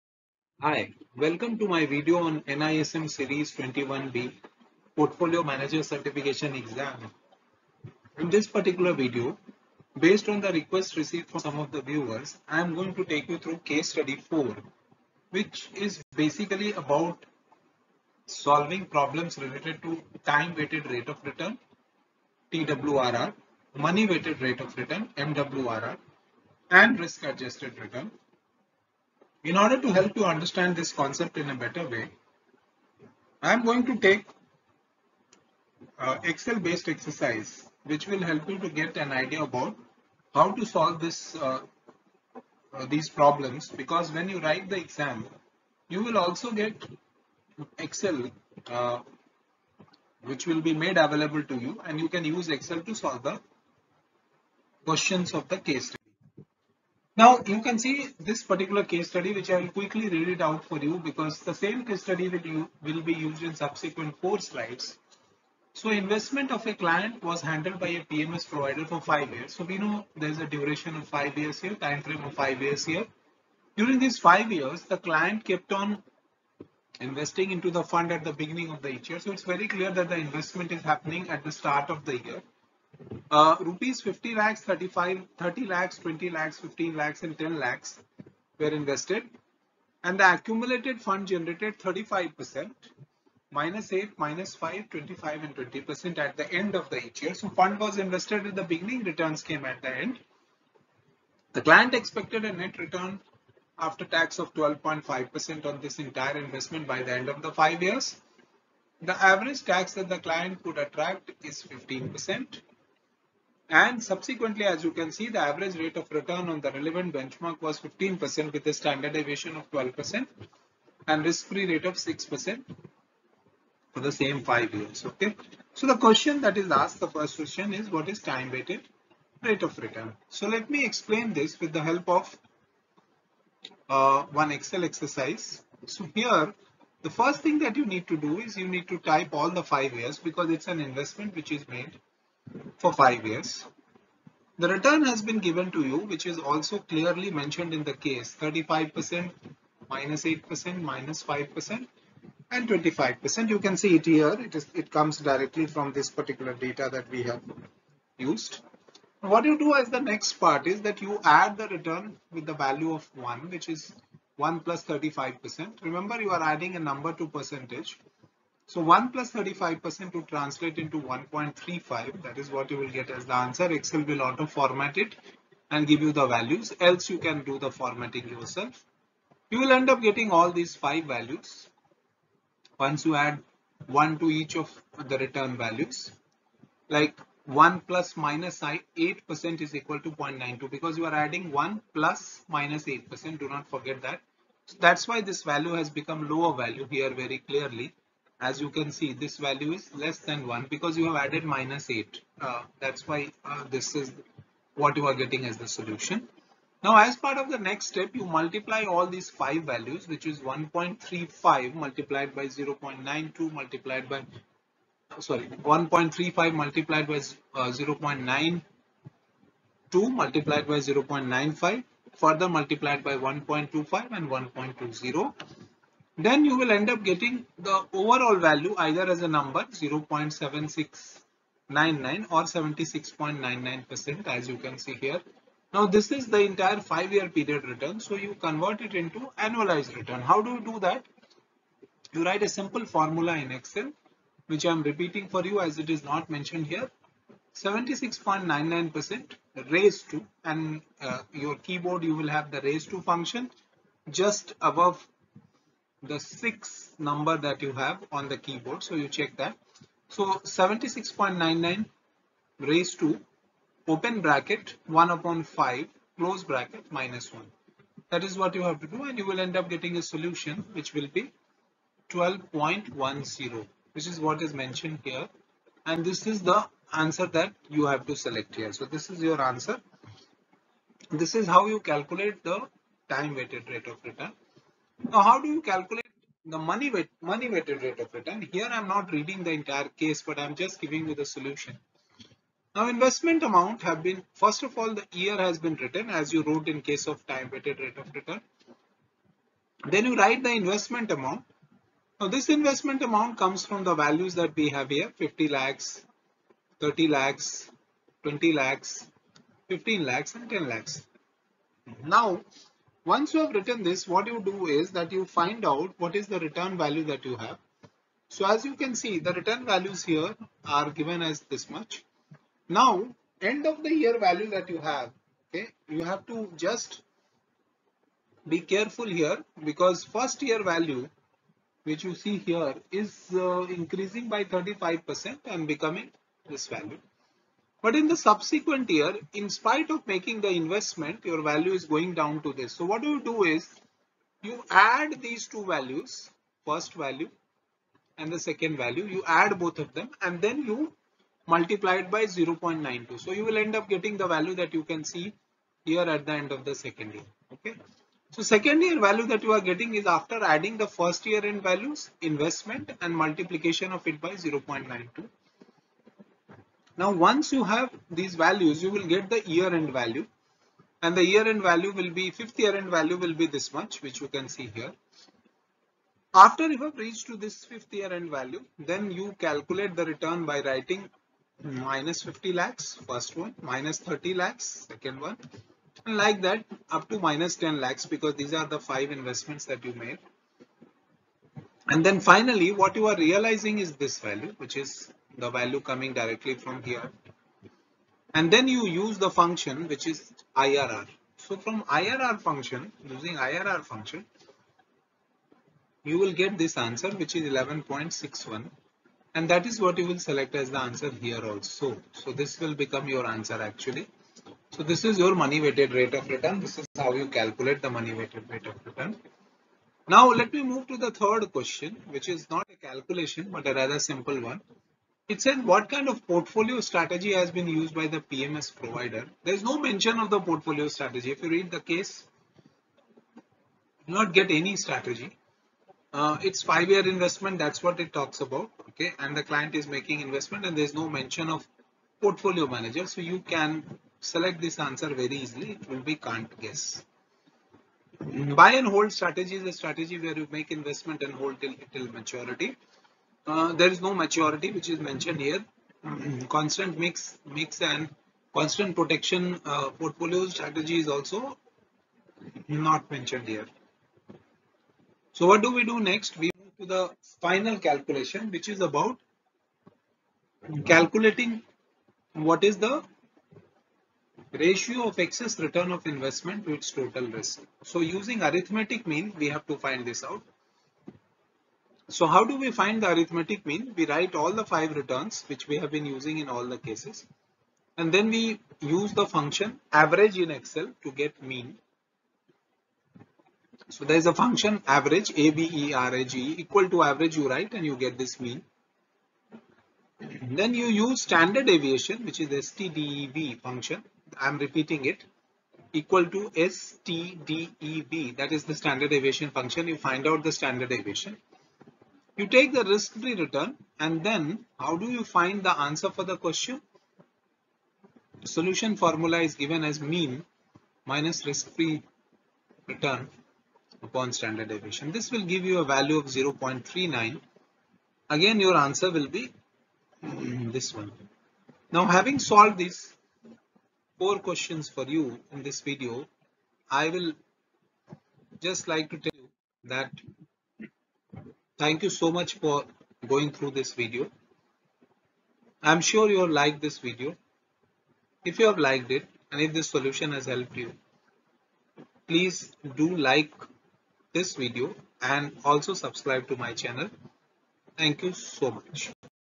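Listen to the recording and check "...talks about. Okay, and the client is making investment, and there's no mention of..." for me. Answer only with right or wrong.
right.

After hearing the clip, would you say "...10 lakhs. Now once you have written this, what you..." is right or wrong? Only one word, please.
right.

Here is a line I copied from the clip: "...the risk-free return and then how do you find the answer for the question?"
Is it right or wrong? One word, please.
right.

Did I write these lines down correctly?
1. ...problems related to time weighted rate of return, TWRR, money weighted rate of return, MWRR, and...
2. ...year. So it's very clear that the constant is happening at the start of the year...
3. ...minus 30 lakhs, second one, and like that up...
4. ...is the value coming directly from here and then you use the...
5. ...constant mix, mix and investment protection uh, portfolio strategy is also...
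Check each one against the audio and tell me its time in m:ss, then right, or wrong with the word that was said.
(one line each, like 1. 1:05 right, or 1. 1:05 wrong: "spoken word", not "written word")
1. 0:18 right
2. 1:18 wrong: "investment", not "constant"
3. 6:23 right
4. 6:34 right
5. 7:36 wrong: "constant", not "investment".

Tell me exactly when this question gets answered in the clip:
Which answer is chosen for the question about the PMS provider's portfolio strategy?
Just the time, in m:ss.
7:26.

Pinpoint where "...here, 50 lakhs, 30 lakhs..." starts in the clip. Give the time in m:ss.
5:04.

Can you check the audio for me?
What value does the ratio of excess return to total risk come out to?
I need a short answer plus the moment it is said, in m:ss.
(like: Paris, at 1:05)
0.39, at 8:46.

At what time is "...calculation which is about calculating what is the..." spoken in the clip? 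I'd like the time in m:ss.
7:47.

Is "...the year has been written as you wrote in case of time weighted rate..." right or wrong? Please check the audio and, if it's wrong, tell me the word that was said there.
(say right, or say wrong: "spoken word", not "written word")
right.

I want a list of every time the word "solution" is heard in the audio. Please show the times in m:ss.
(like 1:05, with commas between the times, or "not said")
3:25, 4:30, 4:51, 8:38, 9:09.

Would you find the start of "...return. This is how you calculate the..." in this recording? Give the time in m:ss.
6:56.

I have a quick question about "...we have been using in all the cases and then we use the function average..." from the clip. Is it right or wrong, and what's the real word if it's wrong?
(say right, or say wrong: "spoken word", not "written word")
right.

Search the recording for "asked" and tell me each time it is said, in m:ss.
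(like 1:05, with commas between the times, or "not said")
2:06.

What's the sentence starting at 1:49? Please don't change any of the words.
The average tax that the client could attract is 15%.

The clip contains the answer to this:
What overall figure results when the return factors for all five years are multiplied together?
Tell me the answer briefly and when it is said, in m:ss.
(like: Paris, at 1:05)
0.7699, at 3:49.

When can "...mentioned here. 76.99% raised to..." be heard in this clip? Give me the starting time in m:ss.
4:06.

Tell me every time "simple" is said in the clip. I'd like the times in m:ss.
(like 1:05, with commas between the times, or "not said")
4:02, 7:03.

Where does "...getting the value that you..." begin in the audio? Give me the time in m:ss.
5:53.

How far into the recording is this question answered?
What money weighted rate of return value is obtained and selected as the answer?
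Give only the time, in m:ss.
6:47.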